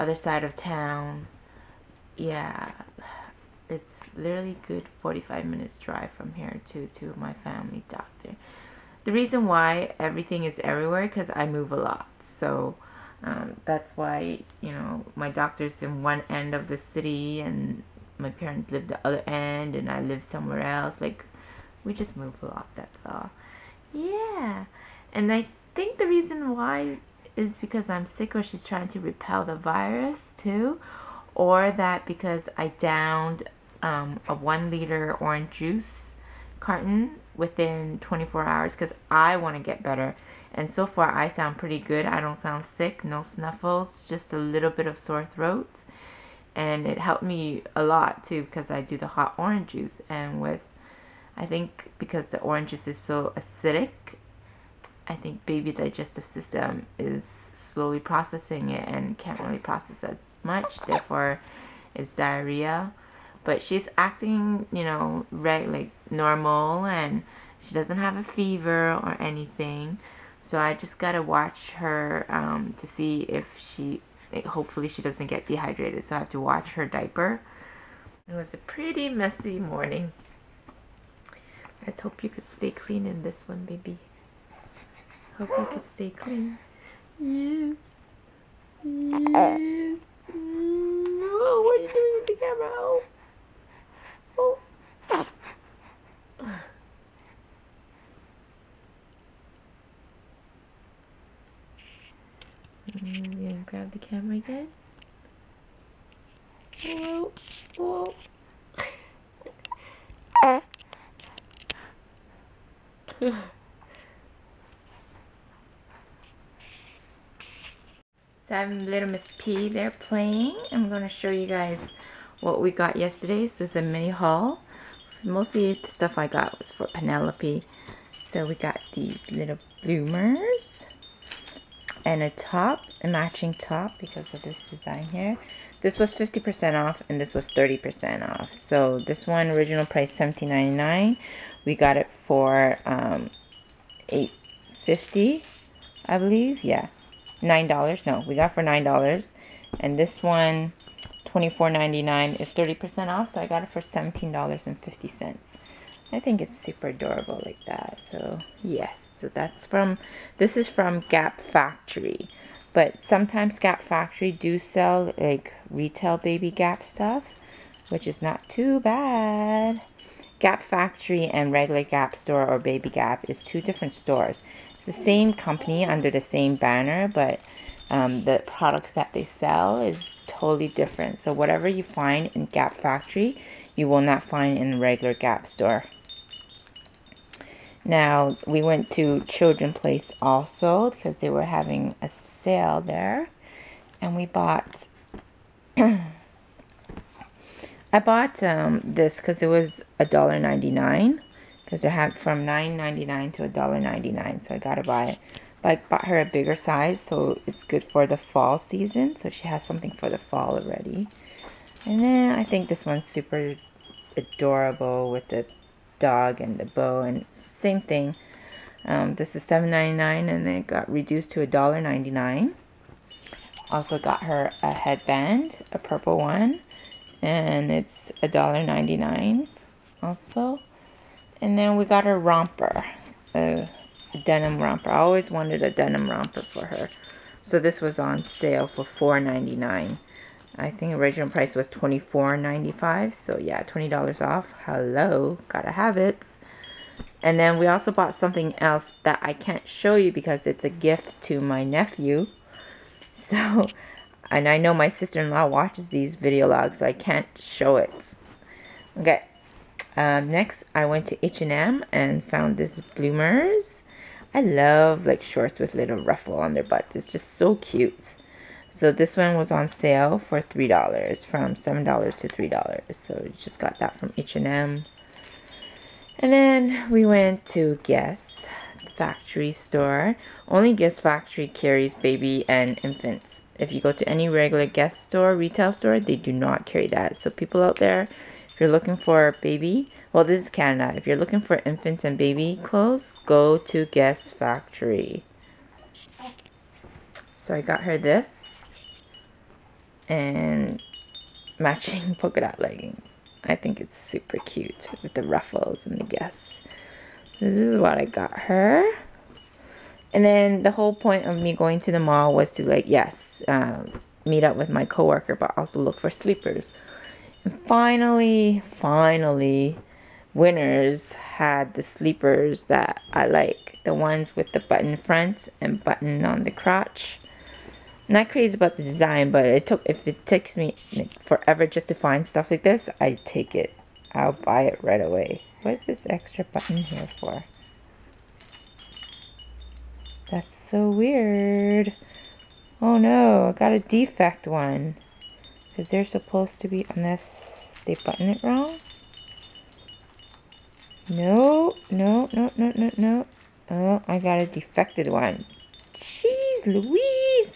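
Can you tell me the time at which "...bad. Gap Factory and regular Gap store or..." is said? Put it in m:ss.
2:48.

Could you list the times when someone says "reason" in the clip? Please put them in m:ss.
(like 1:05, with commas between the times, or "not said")
0:09, 0:26.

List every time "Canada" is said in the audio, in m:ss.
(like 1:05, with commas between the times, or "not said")
4:50.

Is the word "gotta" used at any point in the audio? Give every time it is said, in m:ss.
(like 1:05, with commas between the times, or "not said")
1:10, 4:05.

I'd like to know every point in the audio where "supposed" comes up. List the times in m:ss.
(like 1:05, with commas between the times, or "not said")
5:46.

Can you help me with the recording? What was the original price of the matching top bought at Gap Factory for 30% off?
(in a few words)
$24.99.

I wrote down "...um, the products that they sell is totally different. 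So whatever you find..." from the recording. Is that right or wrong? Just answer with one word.
right.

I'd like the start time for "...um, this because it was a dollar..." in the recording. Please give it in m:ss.
3:18.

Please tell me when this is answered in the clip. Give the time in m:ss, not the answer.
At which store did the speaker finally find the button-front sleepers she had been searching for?
5:20.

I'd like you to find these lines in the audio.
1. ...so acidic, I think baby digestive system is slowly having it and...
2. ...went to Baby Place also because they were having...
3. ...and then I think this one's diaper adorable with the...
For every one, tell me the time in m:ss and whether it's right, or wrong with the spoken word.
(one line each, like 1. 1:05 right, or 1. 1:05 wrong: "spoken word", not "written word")
1. 0:52 wrong: "processing", not "having"
2. 3:08 wrong: "Children", not "Baby"
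3. 3:31 wrong: "super", not "diaper".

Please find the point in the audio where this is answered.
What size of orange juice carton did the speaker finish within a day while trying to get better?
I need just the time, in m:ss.
0:34.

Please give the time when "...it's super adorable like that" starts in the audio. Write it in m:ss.
2:36.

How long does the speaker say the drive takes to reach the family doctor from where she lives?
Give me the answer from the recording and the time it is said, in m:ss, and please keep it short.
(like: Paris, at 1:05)
45 minutes, at 0:05.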